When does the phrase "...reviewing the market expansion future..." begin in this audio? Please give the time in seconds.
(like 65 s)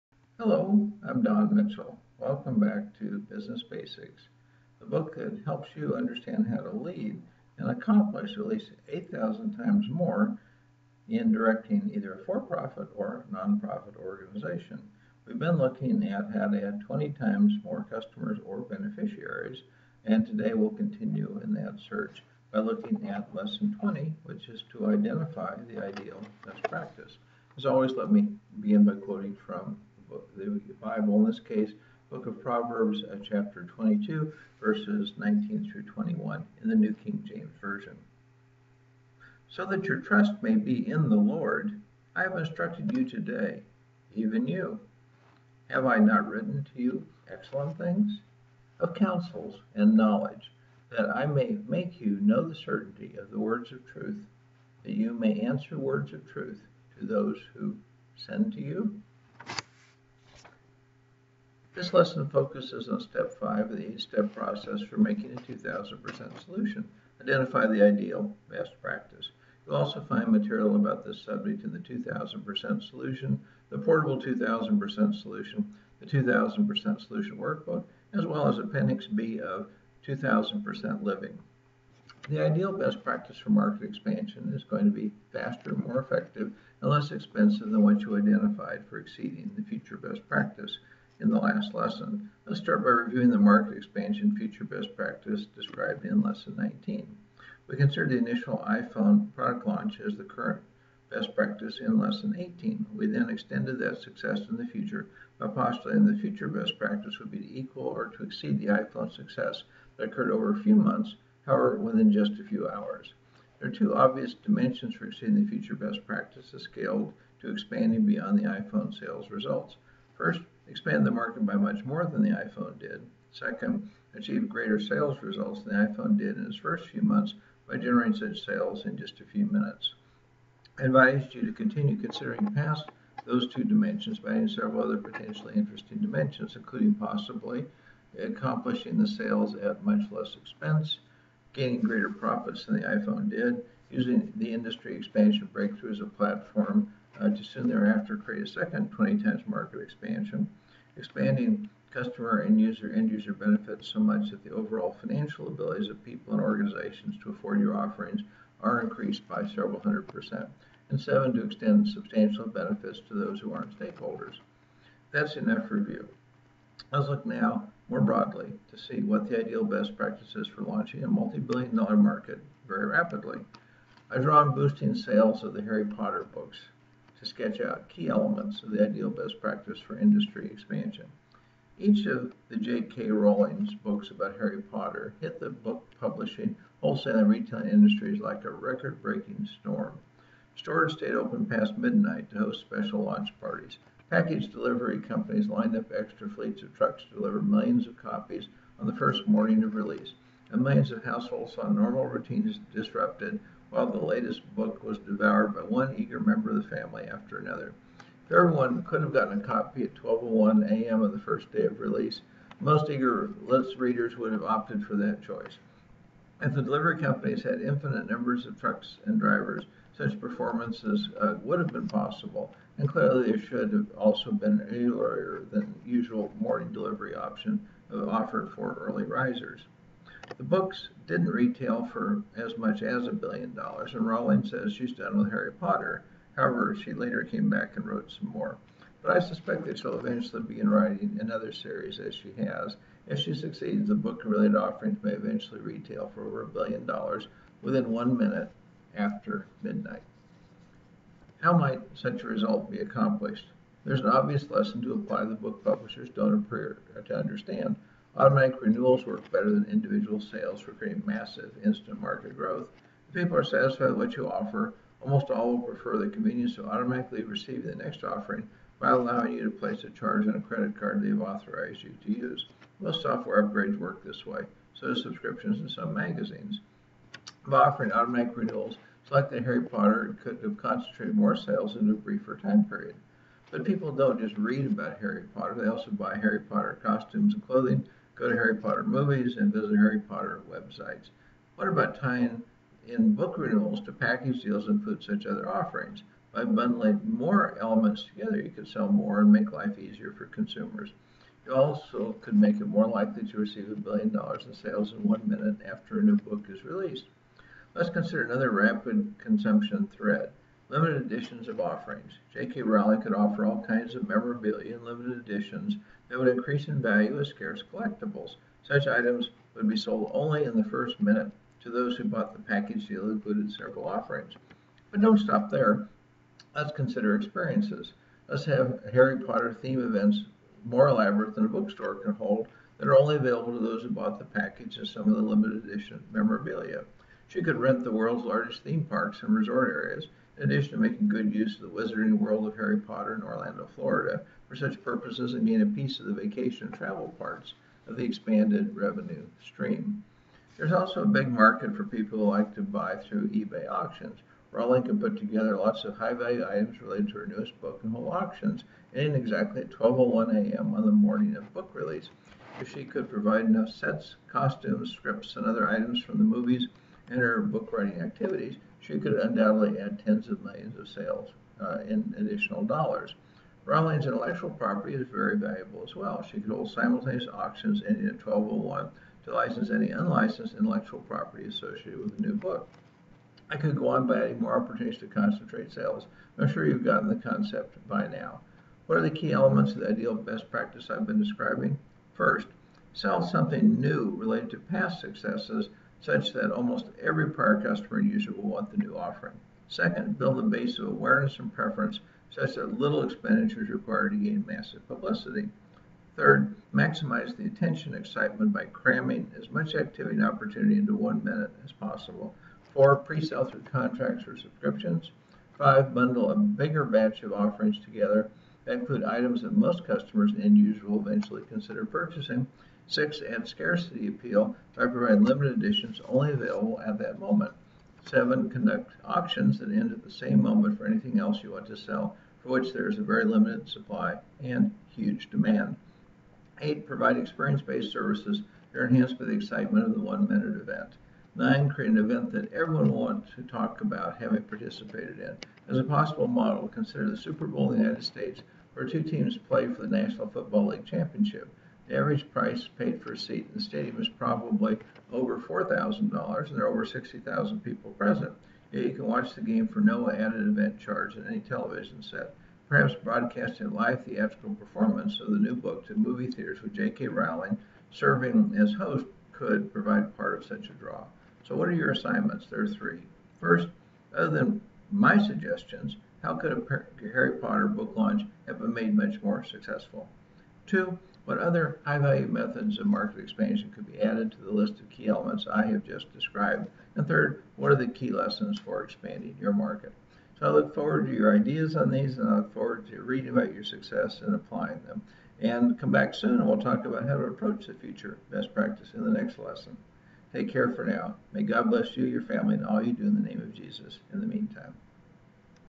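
92 s.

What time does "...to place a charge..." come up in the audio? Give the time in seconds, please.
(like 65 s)
269 s.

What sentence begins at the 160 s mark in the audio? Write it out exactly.
And seven, to extend substantial benefits to those who aren't stakeholders.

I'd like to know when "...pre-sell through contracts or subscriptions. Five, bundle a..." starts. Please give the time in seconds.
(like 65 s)
412 s.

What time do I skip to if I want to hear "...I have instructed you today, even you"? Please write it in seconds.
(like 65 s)
42 s.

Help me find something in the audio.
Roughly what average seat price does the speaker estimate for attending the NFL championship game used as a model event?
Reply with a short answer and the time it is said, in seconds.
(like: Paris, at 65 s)
$4,000, at 455 s.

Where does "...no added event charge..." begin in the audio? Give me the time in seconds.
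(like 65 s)
459 s.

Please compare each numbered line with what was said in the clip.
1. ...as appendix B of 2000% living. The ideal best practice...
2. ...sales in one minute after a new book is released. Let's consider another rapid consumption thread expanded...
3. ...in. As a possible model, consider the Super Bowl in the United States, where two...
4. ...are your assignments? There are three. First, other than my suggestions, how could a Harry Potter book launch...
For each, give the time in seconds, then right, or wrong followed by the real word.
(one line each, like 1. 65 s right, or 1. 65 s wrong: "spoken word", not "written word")
1. 78 s right
2. 304 s wrong: "limited", not "expanded"
3. 445 s right
4. 471 s right.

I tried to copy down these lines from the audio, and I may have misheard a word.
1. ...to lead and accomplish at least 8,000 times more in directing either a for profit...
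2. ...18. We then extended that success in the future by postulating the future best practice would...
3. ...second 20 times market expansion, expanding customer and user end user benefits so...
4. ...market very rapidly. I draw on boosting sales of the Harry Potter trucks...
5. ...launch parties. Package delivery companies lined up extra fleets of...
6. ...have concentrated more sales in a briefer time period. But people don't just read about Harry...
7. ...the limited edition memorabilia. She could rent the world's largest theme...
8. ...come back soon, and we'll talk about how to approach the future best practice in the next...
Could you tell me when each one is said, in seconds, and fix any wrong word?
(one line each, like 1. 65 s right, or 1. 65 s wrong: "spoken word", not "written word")
1. 6 s right
2. 102 s right
3. 148 s right
4. 171 s wrong: "books", not "trucks"
5. 193 s right
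6. 280 s right
7. 335 s right
8. 495 s right.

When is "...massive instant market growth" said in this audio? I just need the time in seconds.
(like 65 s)
261 s.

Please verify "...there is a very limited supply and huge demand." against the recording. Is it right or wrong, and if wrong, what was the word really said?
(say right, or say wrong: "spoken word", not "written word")
right.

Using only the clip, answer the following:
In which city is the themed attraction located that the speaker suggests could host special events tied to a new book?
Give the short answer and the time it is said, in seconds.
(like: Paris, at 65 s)
Orlando, Florida, at 343 s.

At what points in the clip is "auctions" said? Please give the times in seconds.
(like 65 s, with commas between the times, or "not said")
353 s, 358 s, 377 s, 429 s.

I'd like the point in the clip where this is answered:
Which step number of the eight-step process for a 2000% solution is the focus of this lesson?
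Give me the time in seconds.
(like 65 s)
62 s.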